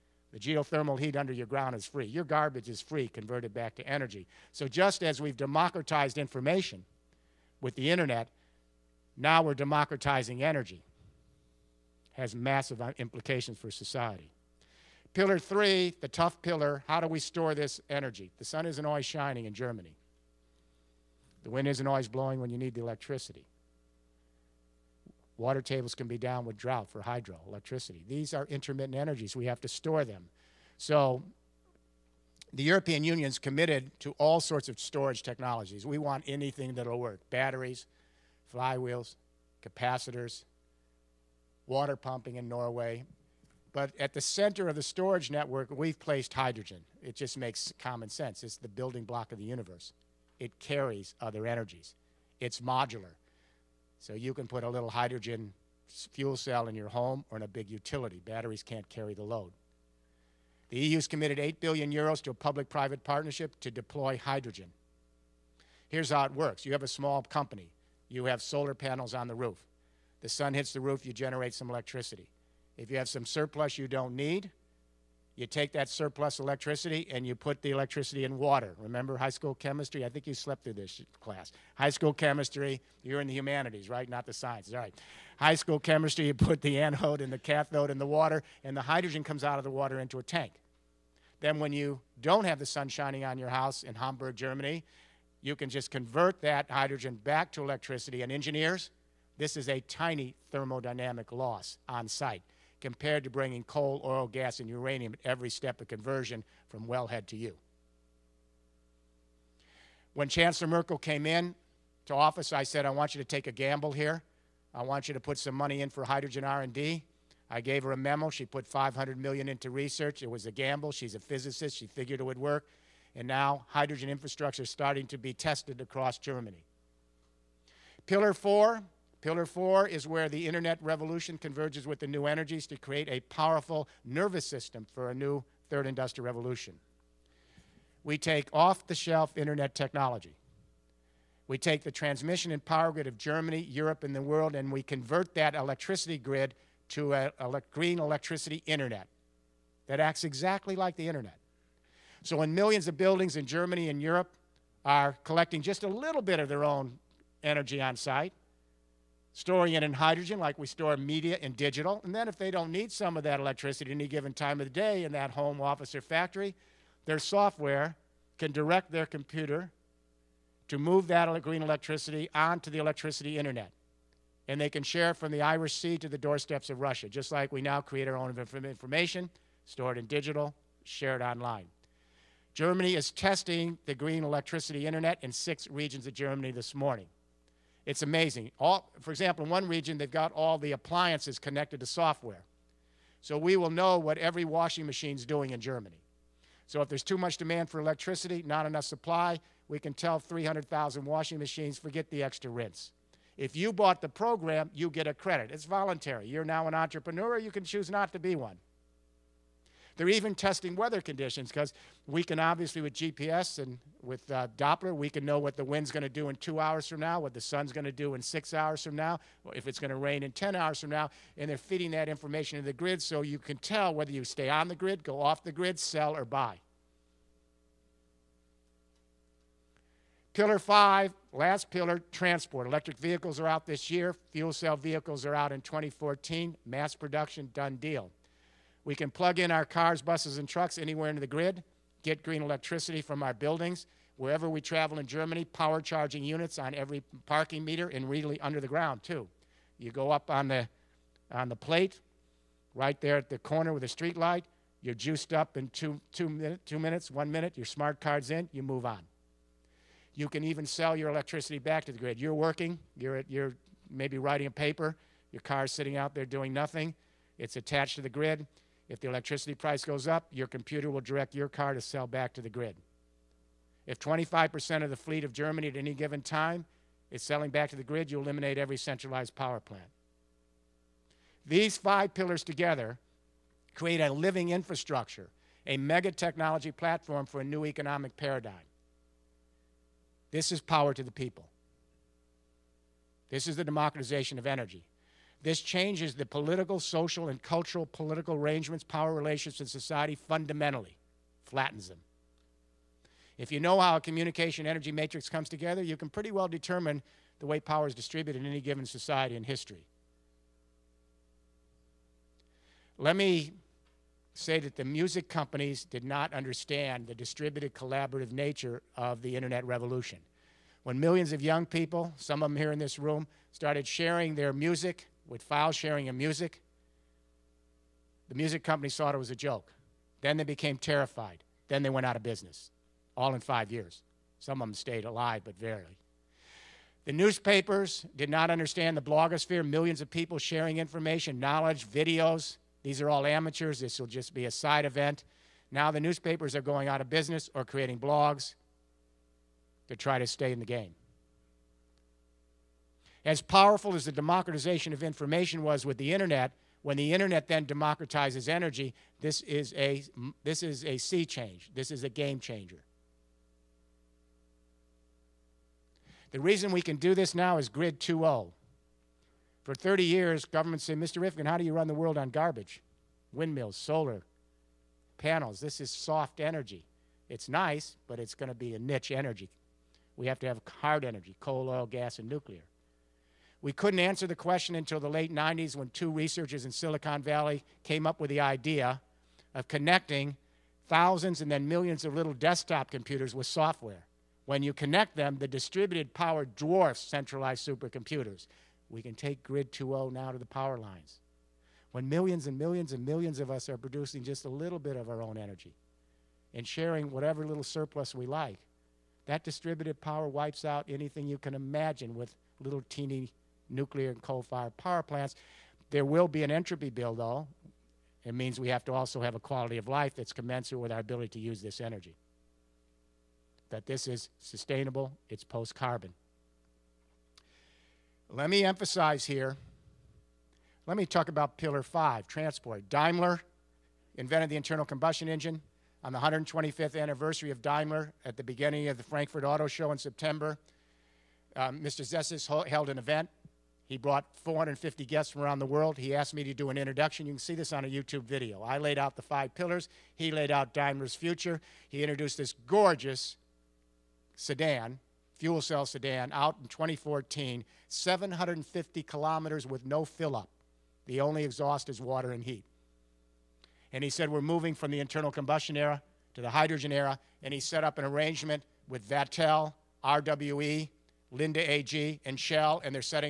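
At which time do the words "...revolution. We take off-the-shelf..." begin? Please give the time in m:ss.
2:16.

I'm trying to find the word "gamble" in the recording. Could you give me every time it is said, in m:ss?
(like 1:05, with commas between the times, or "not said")
1:53, 2:00.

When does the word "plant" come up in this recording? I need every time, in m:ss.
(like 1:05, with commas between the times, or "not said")
4:39, 6:55.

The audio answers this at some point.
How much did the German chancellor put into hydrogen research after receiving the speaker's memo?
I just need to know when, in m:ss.
1:58.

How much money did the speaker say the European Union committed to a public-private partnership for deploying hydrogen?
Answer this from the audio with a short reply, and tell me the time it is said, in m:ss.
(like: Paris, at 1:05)
8 billion euros, at 1:01.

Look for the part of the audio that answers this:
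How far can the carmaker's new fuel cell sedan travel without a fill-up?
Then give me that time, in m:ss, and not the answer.
7:37.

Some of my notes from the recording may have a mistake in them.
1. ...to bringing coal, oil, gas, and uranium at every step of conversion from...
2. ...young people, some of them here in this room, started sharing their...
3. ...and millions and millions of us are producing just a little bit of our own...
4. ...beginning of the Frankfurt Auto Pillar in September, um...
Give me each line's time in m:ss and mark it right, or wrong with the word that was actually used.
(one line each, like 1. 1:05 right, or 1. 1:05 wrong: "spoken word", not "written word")
1. 1:43 right
2. 5:21 right
3. 6:42 right
4. 7:18 wrong: "Show", not "Pillar".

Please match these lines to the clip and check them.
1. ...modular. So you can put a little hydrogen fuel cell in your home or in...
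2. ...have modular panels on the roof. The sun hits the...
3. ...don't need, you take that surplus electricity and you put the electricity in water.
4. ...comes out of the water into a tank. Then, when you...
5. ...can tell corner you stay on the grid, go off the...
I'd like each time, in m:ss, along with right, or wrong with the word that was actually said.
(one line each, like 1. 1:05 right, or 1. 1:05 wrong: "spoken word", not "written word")
1. 0:52 right
2. 1:08 wrong: "solar", not "modular"
3. 1:13 right
4. 1:29 right
5. 3:43 wrong: "whether", not "corner".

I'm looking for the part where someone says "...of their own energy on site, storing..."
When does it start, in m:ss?
2:36.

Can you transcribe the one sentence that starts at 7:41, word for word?
The only exhaust is water and heat.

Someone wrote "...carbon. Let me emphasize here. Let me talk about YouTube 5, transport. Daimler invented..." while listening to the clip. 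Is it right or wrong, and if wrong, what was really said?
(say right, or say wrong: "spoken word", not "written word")
wrong: "Pillar", not "YouTube".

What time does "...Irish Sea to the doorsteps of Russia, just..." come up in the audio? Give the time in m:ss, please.
2:55.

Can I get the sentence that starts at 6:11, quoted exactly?
Rifkin, how do you run the world on garbage?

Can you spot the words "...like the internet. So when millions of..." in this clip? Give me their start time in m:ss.
2:30.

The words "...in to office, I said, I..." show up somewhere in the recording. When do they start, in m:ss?
1:51.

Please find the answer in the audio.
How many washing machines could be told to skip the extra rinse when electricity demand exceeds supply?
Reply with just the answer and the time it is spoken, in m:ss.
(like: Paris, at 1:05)
300,000, at 3:20.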